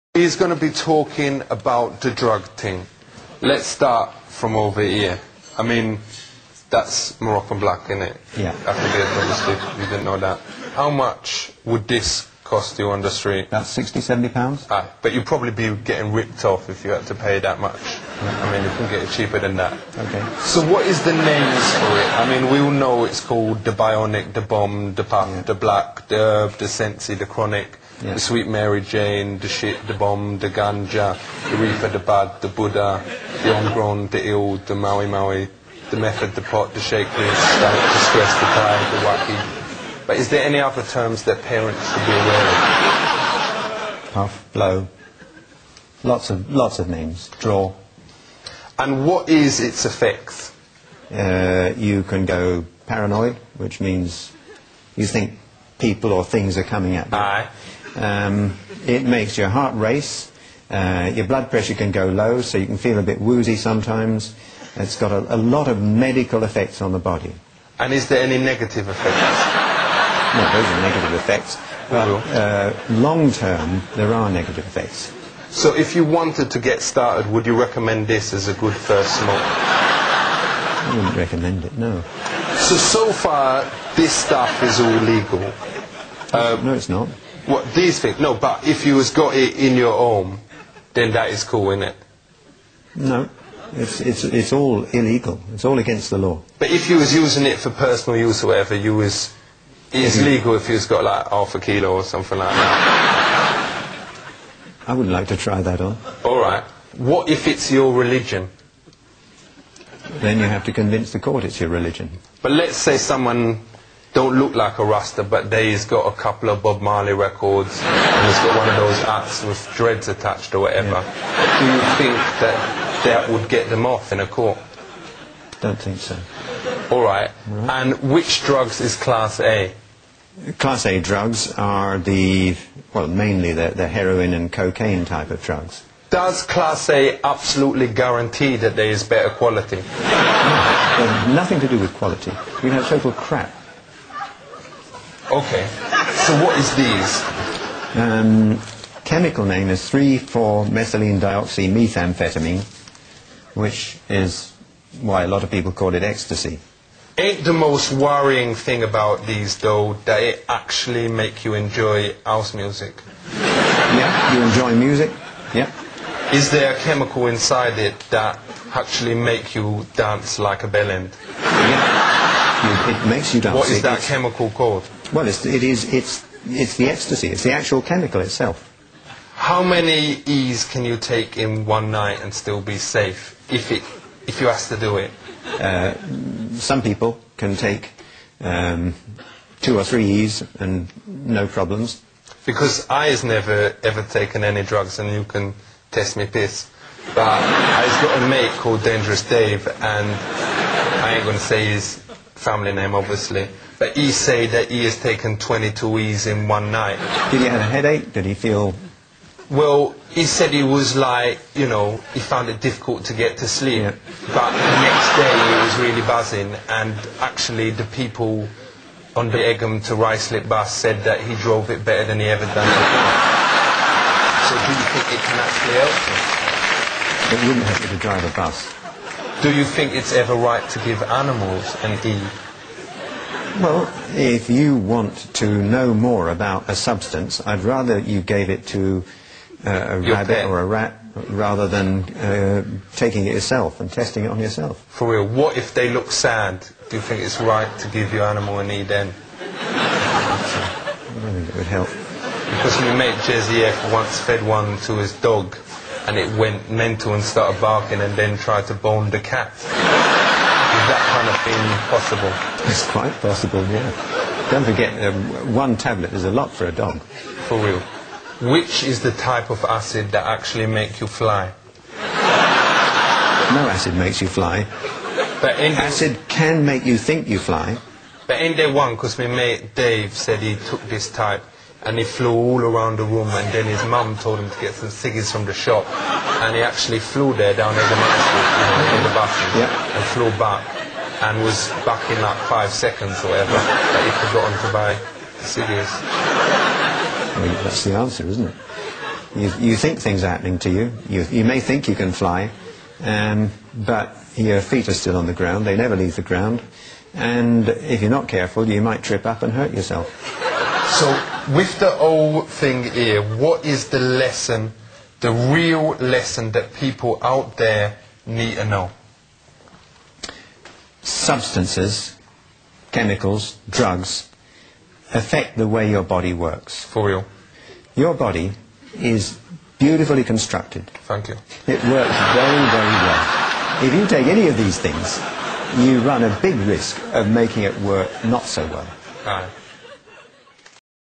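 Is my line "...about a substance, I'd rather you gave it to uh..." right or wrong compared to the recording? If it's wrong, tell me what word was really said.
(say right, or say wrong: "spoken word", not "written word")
right.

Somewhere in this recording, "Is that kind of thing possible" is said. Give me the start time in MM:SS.
04:19.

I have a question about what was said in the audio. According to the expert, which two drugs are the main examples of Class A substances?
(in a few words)
heroin and cocaine.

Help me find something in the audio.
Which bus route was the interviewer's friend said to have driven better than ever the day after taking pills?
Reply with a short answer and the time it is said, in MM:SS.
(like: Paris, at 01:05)
Egham to Ruislip, at 03:39.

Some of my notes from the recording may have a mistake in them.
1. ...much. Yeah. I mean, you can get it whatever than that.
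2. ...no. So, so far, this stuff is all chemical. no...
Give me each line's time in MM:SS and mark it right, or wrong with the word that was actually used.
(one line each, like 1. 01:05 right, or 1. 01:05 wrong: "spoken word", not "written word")
1. 00:17 wrong: "cheaper", not "whatever"
2. 01:21 wrong: "legal", not "chemical".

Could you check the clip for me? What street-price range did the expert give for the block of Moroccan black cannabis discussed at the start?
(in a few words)
60 to 70 pounds.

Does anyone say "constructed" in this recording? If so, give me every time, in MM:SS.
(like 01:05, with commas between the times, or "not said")
05:30.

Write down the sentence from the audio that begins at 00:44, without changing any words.
Puff, blow, lots of lots of names.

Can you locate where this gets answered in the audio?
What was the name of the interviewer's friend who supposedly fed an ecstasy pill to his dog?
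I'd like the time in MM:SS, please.
04:13.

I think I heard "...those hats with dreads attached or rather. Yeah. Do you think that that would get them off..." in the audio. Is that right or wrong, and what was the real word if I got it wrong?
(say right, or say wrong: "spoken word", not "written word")
wrong: "whatever", not "rather".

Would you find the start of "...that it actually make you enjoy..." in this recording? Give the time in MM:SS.
02:40.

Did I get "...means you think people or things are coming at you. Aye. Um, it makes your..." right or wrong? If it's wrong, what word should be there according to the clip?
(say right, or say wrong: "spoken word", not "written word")
right.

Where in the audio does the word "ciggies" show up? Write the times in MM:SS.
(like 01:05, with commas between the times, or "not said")
04:44, 04:55.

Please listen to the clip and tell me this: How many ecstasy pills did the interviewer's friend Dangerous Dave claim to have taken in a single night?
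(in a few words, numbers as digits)
22.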